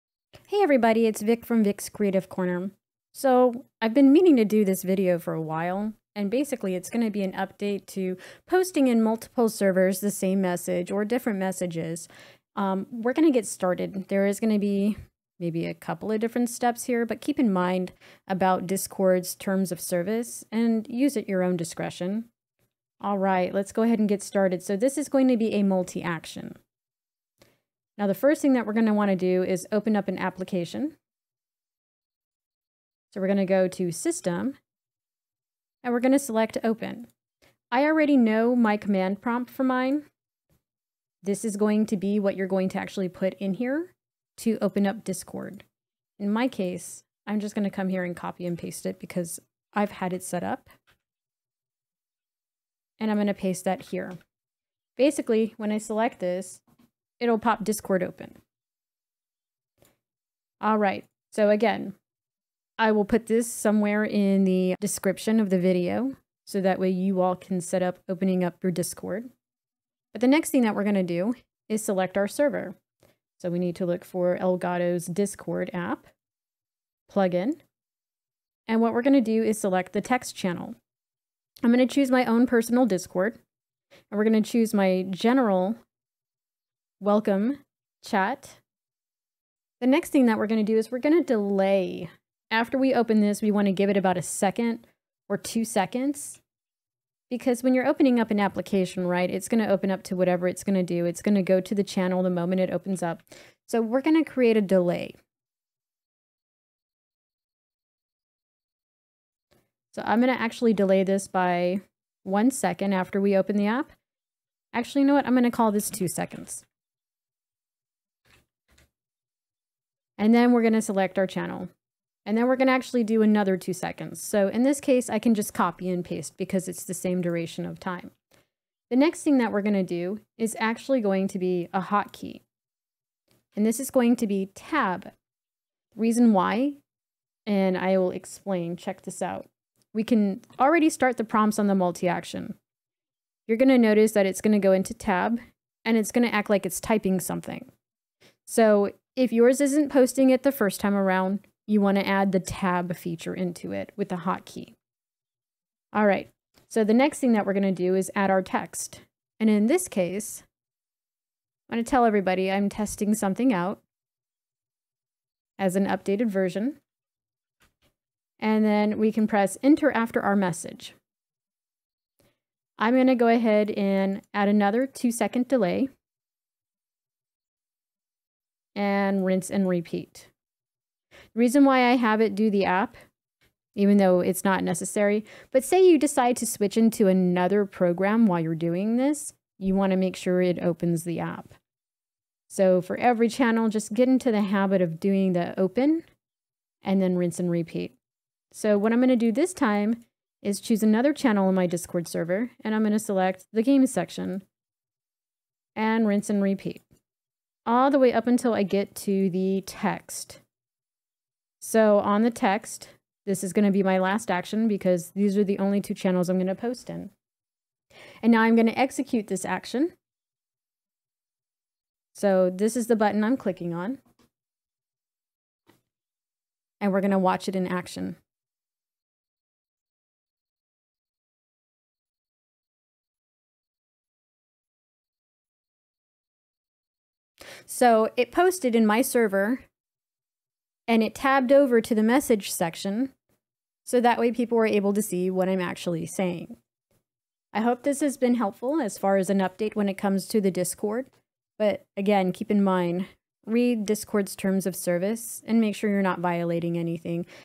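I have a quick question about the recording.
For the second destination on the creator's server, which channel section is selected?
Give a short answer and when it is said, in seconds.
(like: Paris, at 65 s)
games section, at 203 s.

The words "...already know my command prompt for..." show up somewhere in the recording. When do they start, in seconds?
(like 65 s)
37 s.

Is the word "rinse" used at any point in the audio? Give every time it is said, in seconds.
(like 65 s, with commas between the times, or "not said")
179 s, 197 s, 206 s.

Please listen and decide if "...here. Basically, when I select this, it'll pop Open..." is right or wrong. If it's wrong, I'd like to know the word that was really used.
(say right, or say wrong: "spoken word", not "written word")
wrong: "Discord", not "Open".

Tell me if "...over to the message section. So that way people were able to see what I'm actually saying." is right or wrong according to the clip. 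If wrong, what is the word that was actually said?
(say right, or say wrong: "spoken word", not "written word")
right.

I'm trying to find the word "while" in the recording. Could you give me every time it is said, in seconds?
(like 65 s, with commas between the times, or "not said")
5 s, 188 s.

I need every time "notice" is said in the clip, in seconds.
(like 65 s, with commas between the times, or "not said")
143 s.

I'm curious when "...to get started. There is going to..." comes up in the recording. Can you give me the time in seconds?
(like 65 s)
13 s.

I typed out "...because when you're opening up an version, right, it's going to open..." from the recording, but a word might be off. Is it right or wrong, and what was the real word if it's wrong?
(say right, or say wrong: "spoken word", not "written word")
wrong: "application", not "version".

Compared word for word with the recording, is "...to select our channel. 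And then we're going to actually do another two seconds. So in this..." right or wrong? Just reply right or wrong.
right.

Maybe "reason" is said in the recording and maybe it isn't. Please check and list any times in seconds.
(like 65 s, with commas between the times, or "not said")
135 s, 181 s.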